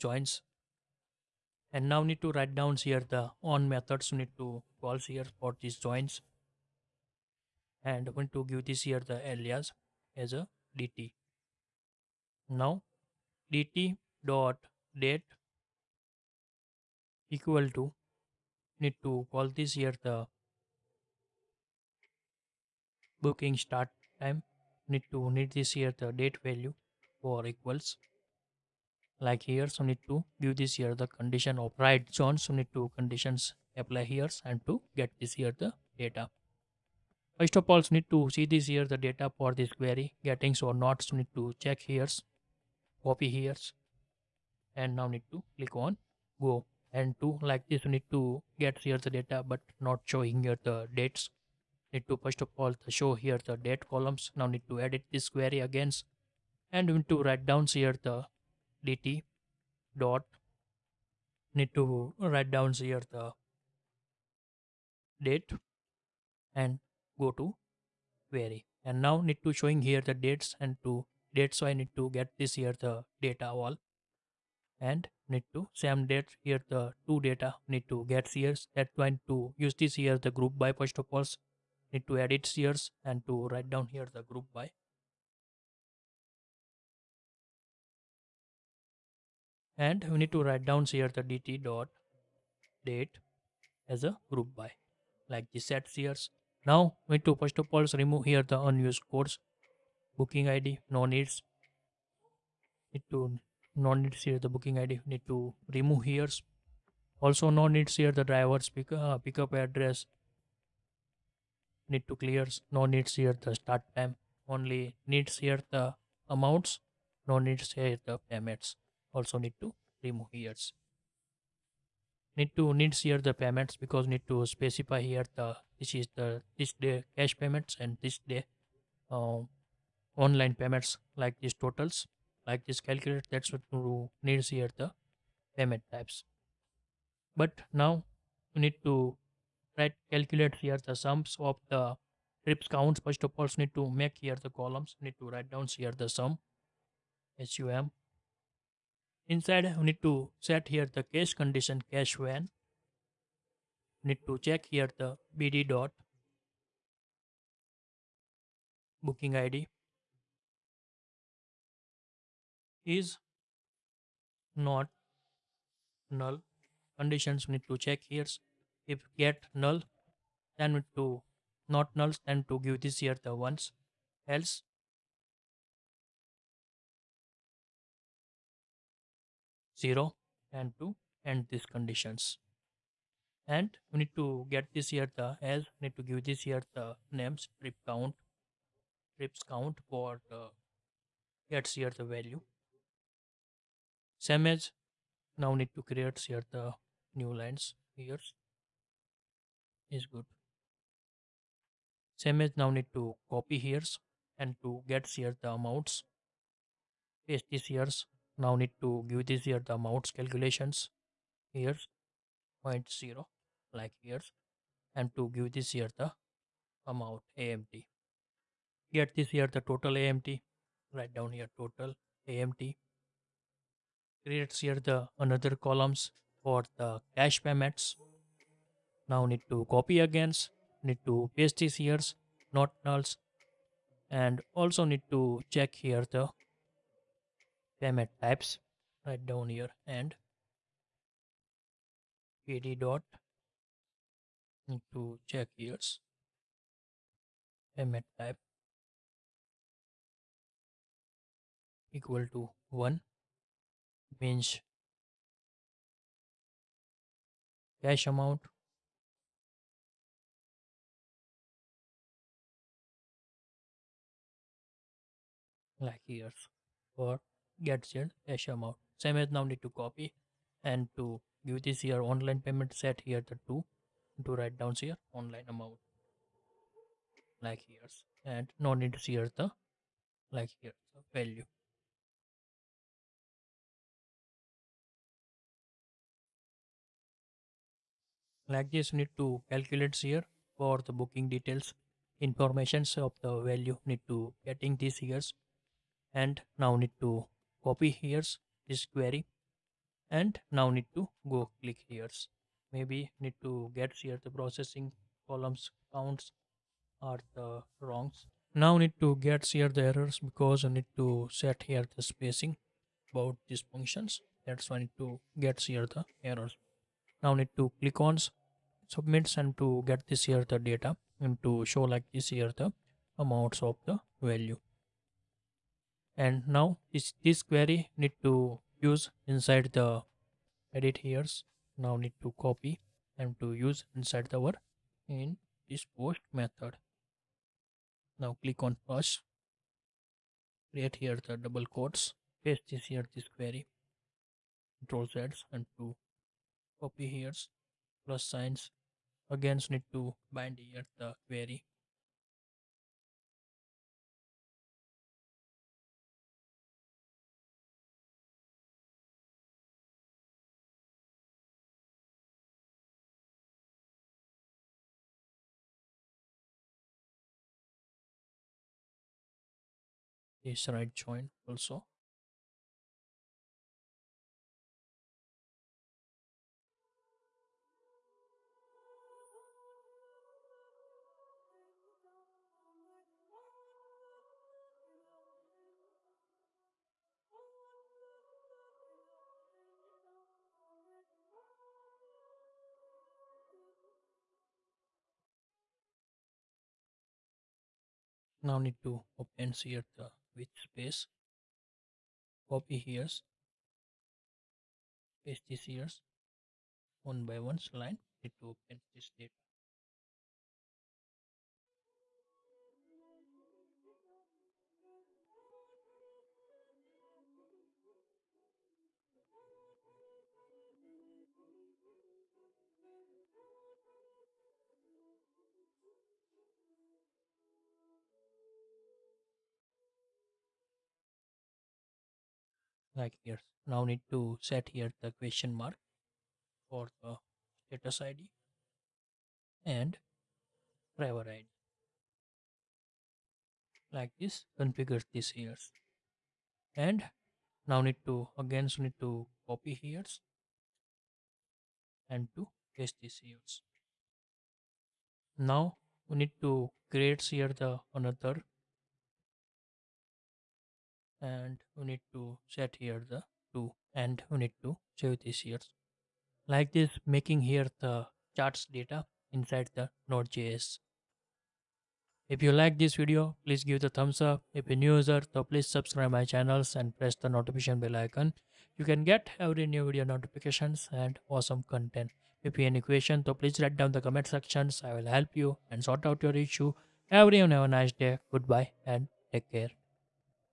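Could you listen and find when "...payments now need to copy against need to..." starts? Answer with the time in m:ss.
3:47.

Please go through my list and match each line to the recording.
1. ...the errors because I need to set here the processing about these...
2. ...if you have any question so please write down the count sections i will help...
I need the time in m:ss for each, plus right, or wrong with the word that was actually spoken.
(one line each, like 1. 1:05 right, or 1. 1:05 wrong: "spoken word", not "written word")
1. 5:09 wrong: "spacing", not "processing"
2. 8:02 wrong: "comment", not "count".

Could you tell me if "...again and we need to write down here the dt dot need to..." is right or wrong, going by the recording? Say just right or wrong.
right.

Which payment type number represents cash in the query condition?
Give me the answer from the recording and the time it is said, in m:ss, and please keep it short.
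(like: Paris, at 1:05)
1, at 4:12.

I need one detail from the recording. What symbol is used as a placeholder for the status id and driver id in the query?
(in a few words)
question mark.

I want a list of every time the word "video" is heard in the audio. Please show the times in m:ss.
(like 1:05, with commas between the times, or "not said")
7:52, 7:59.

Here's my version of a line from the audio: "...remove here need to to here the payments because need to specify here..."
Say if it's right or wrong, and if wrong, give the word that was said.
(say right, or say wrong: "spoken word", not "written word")
right.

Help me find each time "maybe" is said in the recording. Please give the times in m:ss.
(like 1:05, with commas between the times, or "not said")
5:02.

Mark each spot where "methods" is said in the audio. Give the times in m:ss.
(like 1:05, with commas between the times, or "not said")
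0:03, 5:36.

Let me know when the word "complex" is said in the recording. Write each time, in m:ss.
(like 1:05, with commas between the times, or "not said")
not said.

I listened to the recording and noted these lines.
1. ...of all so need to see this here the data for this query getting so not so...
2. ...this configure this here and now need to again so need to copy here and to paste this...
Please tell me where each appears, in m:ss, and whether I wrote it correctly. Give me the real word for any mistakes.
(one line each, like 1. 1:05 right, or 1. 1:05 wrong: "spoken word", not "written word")
1. 0:37 right
2. 7:24 right.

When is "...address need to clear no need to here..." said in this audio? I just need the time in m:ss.
1:49.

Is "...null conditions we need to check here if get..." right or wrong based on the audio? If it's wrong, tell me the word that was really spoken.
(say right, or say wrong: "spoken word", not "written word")
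right.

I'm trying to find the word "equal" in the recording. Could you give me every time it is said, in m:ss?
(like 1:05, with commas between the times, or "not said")
0:17, 0:27, 4:11.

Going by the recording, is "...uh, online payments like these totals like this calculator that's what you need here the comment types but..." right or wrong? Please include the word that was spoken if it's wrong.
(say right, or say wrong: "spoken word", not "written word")
wrong: "payment", not "comment".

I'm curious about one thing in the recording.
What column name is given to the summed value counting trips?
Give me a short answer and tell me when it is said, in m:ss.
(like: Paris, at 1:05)
trips count, at 3:09.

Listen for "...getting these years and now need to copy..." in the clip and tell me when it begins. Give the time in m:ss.
4:54.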